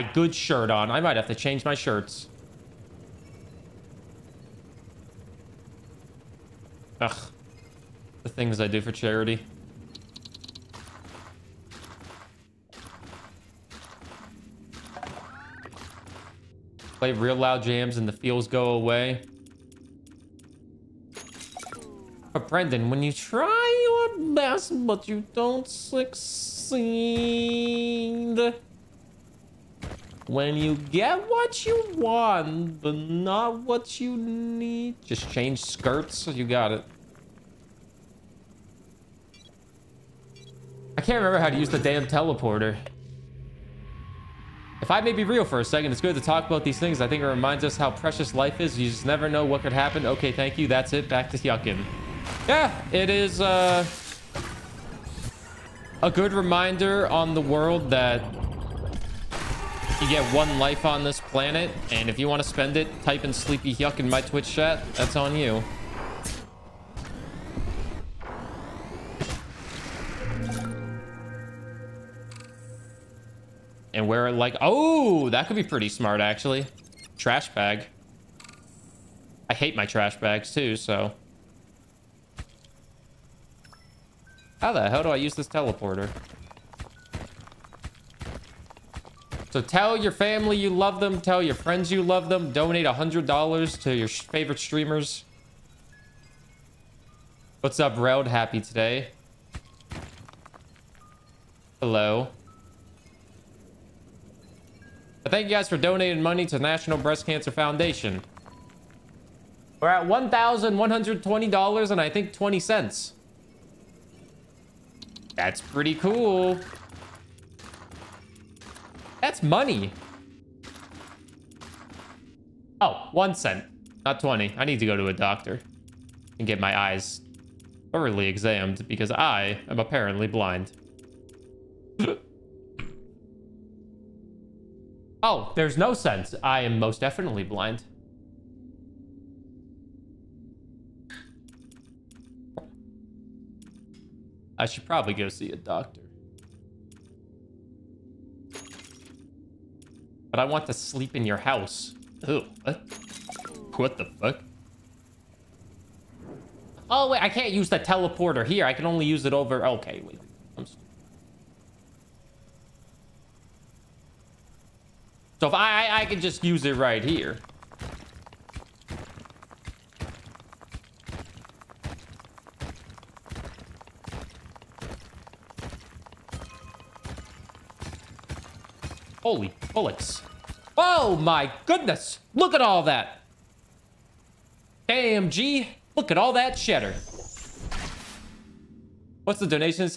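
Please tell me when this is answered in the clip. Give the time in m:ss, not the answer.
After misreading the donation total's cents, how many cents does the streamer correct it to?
2:03.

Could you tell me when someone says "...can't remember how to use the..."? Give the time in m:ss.
0:41.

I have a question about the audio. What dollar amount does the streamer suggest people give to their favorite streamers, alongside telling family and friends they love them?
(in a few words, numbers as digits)
$100.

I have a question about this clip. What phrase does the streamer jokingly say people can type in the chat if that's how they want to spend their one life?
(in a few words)
Sleepy yuckin.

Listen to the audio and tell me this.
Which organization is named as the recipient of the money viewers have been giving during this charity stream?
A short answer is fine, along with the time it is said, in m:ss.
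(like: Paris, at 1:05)
National Breast Cancer Foundation, at 1:46.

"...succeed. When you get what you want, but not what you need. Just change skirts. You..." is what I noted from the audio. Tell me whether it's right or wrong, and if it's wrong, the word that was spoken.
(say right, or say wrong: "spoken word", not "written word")
right.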